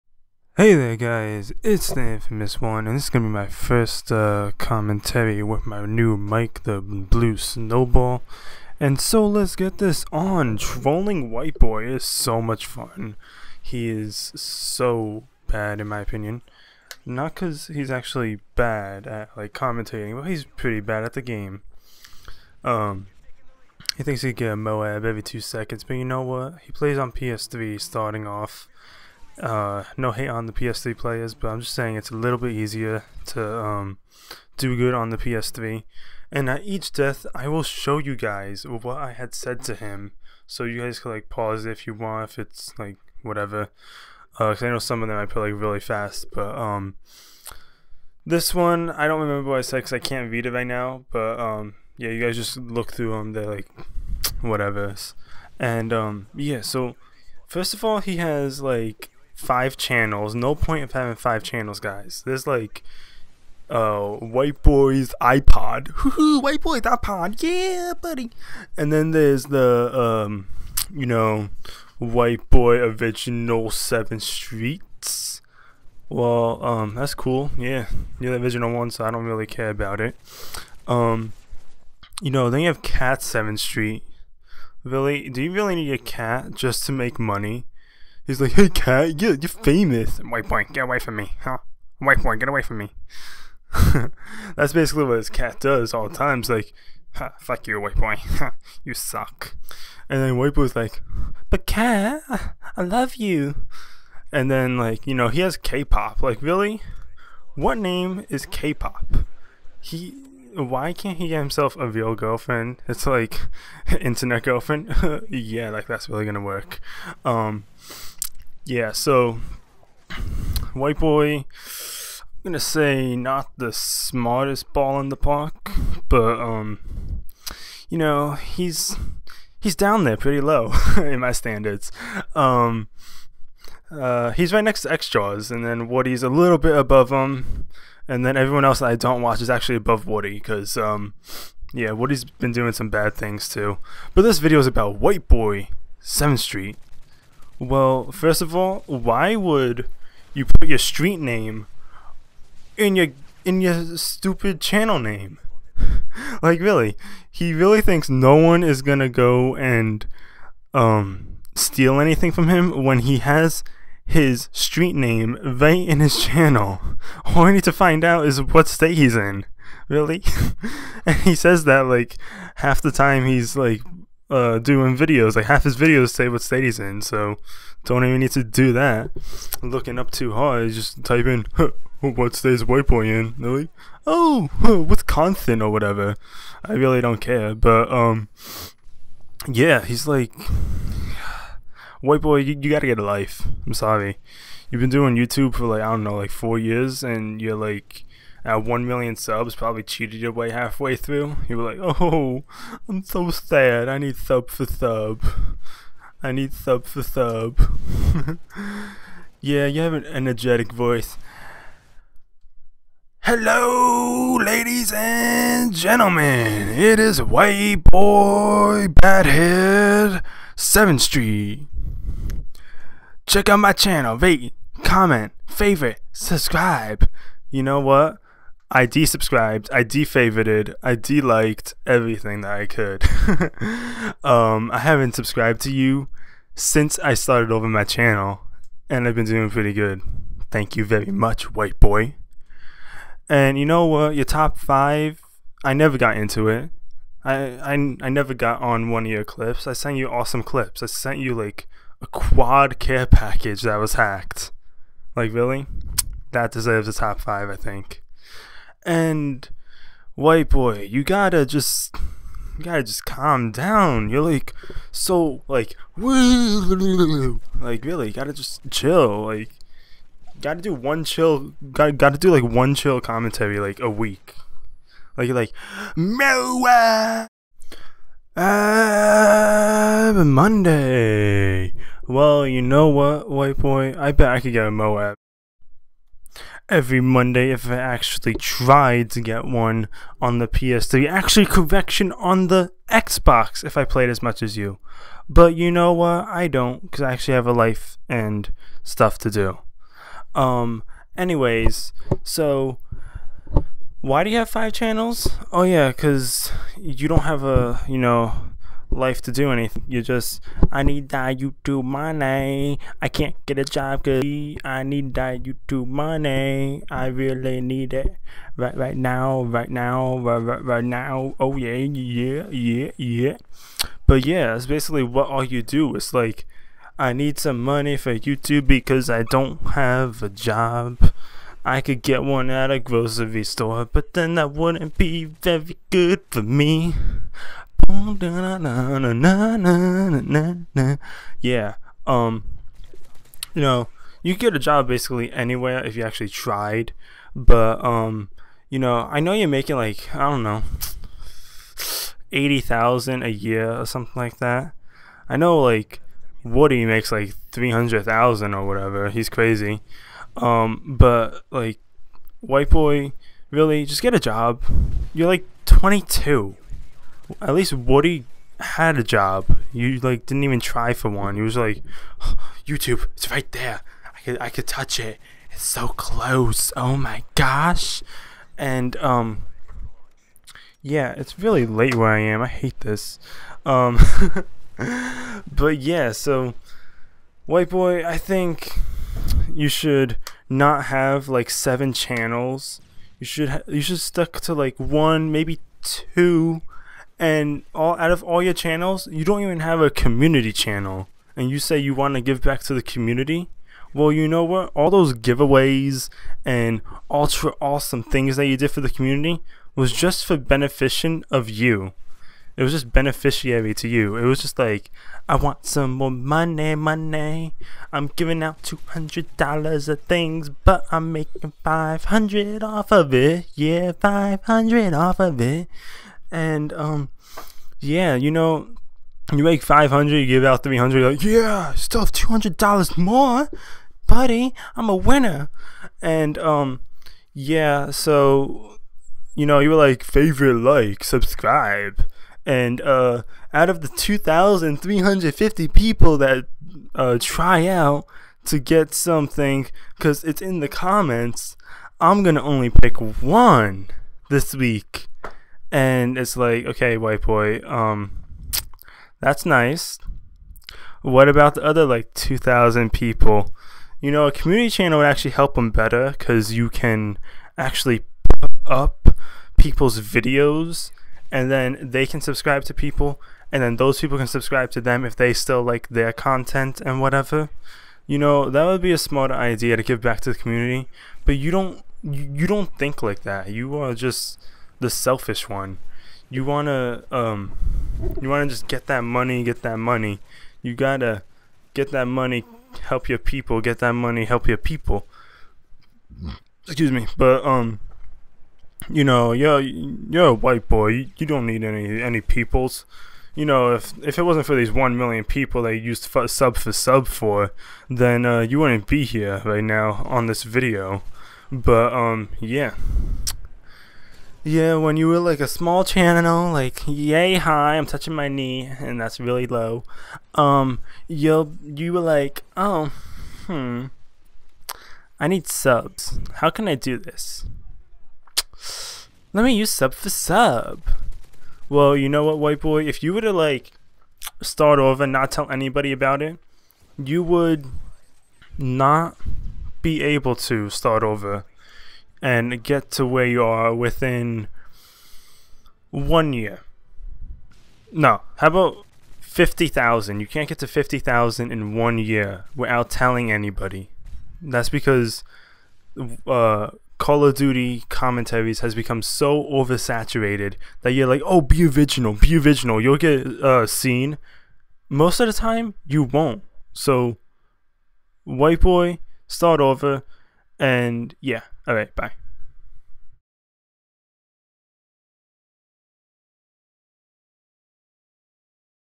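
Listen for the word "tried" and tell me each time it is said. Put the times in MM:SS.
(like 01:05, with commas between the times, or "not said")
04:48, 05:46.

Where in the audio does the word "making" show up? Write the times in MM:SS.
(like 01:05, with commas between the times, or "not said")
05:49, 07:01.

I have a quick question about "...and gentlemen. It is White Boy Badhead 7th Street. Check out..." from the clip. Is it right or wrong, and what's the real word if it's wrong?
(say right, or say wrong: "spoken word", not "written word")
right.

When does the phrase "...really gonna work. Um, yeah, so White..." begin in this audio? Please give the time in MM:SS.
01:56.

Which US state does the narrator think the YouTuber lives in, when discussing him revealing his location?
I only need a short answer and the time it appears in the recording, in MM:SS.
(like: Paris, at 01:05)
Wisconsin, at 03:04.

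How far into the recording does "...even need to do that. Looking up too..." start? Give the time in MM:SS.
02:58.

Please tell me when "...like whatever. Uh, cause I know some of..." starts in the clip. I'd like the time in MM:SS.
00:42.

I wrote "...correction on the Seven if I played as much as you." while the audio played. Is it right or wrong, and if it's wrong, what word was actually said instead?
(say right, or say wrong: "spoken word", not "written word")
wrong: "Xbox", not "Seven".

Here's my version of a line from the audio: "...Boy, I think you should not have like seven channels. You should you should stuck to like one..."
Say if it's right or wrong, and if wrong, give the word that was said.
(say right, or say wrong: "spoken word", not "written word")
right.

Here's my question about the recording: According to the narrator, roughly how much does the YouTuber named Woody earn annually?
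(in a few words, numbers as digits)
300,000.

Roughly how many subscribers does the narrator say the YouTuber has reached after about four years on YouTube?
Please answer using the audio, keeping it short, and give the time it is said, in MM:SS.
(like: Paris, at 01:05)
1 million, at 03:18.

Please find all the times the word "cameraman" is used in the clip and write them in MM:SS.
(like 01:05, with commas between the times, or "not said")
not said.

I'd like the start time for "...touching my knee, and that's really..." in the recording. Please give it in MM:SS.
08:37.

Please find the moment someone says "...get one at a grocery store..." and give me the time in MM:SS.
05:32.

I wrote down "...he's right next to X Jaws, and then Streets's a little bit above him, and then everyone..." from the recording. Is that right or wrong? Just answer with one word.
wrong.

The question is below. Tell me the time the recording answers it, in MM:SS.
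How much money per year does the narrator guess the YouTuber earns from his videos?
05:52.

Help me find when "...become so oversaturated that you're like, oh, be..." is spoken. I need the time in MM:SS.
09:18.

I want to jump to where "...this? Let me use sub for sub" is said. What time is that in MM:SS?
08:46.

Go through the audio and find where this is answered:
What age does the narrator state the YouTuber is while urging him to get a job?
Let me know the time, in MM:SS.
06:05.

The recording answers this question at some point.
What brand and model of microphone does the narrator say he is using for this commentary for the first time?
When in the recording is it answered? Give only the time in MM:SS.
00:06.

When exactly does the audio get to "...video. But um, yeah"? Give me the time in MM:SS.
08:30.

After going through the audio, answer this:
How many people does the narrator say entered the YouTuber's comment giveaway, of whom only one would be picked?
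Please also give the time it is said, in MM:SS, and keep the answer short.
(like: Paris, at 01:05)
2,350, at 07:23.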